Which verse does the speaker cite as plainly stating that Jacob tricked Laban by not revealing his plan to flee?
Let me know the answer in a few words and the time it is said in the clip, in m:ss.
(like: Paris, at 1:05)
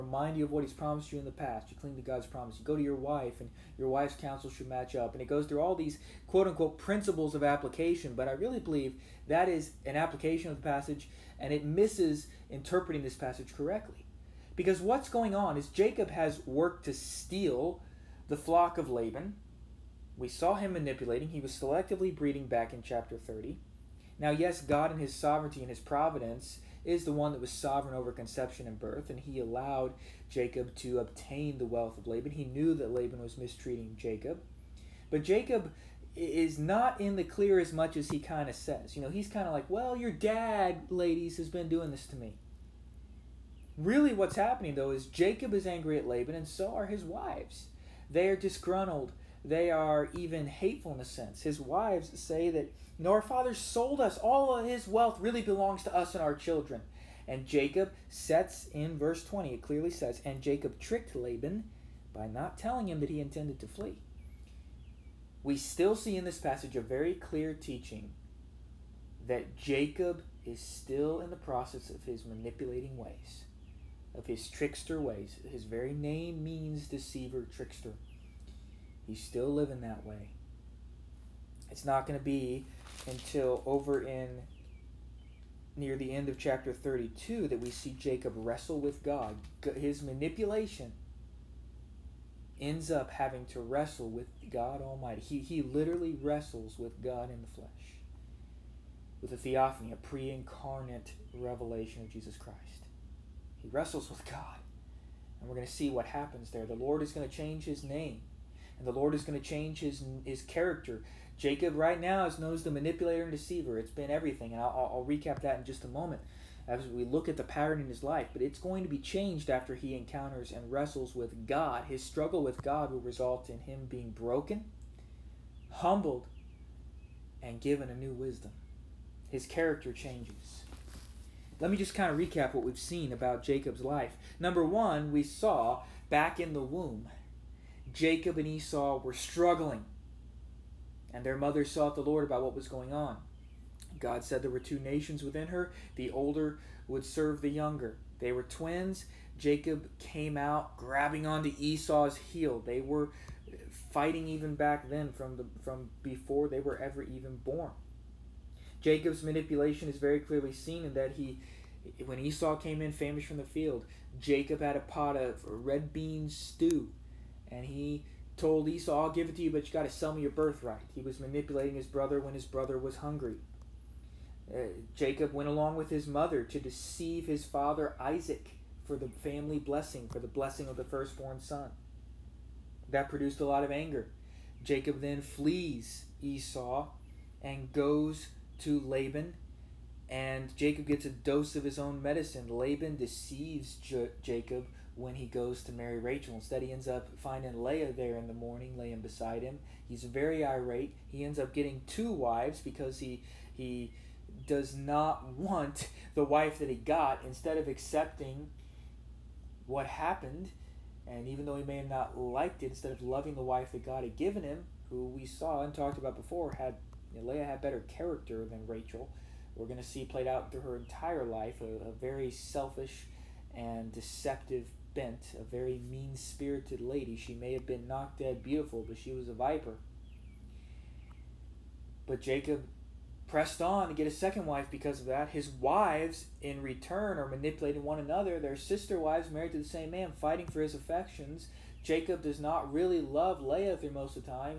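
Verse 20, at 0:58.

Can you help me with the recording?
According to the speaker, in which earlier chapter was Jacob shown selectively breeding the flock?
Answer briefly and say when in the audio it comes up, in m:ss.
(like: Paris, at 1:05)
Chapter 30, at 0:22.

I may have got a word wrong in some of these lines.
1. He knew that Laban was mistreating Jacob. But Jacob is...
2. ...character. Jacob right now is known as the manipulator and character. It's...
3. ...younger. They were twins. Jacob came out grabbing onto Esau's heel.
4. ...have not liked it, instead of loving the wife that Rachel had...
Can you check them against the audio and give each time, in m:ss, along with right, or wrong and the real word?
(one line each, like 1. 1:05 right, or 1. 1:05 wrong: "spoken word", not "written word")
1. 0:32 right
2. 1:50 wrong: "deceiver", not "character"
3. 2:27 right
4. 3:31 wrong: "God", not "Rachel".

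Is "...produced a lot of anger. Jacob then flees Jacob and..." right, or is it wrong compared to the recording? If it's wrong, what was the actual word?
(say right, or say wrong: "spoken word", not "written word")
wrong: "Esau", not "Jacob".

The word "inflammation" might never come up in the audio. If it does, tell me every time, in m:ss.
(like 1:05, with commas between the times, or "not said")
not said.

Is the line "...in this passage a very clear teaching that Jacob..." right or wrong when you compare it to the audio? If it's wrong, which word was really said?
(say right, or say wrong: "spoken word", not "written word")
right.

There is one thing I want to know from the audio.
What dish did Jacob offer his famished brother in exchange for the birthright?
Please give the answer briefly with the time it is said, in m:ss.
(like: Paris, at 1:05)
Red bean stew, at 2:45.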